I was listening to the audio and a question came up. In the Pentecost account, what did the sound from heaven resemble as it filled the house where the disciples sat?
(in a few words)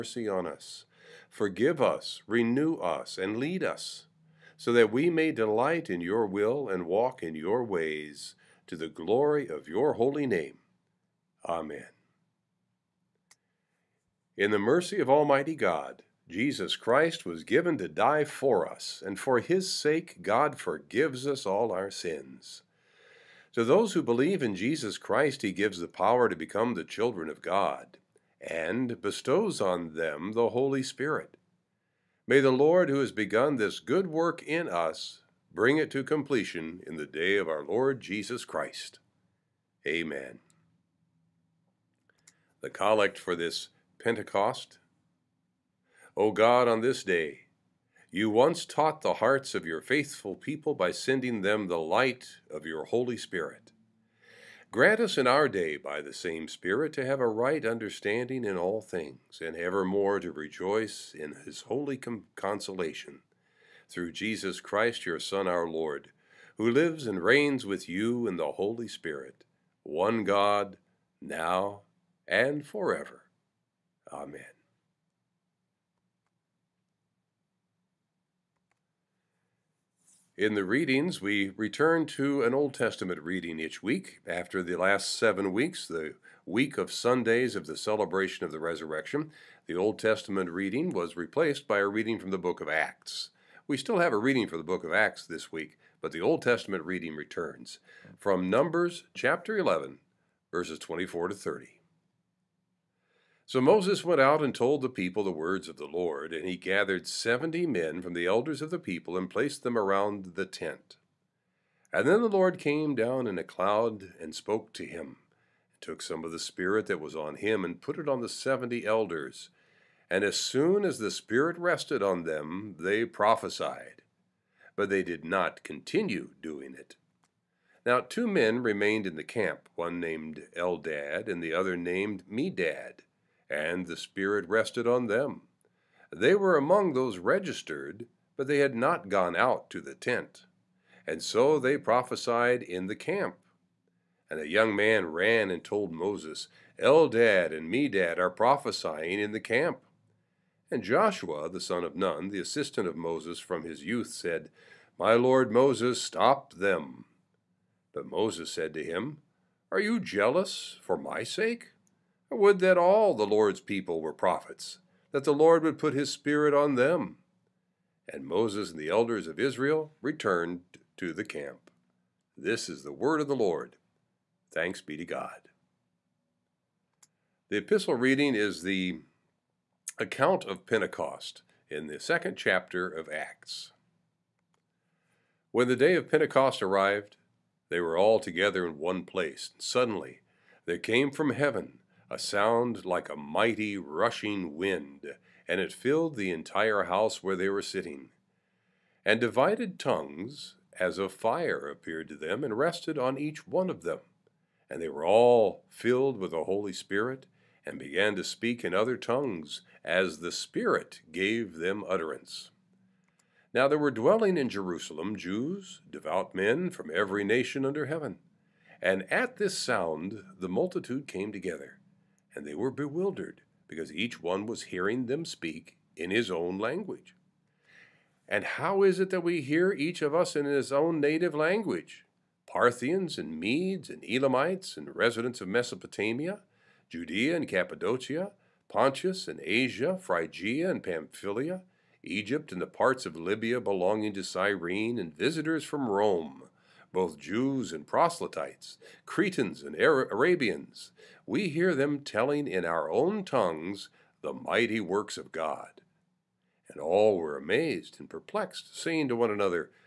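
a mighty rushing wind.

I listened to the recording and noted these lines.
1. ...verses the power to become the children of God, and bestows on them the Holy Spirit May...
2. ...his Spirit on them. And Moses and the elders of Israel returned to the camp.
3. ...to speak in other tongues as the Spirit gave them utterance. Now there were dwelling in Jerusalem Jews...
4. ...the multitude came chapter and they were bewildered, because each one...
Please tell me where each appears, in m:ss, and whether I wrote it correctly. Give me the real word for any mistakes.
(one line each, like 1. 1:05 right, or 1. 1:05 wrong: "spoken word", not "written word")
1. 0:25 wrong: "gives", not "verses"
2. 2:45 right
3. 3:28 right
4. 3:40 wrong: "together", not "chapter".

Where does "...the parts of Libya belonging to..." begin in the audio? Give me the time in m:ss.
4:02.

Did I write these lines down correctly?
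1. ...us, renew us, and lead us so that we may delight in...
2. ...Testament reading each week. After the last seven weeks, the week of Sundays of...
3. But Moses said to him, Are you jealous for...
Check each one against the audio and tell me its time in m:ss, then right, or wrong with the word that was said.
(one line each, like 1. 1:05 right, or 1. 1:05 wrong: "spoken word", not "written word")
1. 0:01 right
2. 1:22 right
3. 2:37 right.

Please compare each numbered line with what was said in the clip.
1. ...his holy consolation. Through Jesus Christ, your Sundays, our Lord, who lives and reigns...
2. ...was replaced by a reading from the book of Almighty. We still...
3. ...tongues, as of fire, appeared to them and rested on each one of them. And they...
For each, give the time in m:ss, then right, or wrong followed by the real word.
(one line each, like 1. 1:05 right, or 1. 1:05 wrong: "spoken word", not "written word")
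1. 1:01 wrong: "Son", not "Sundays"
2. 1:30 wrong: "Acts", not "Almighty"
3. 3:19 right.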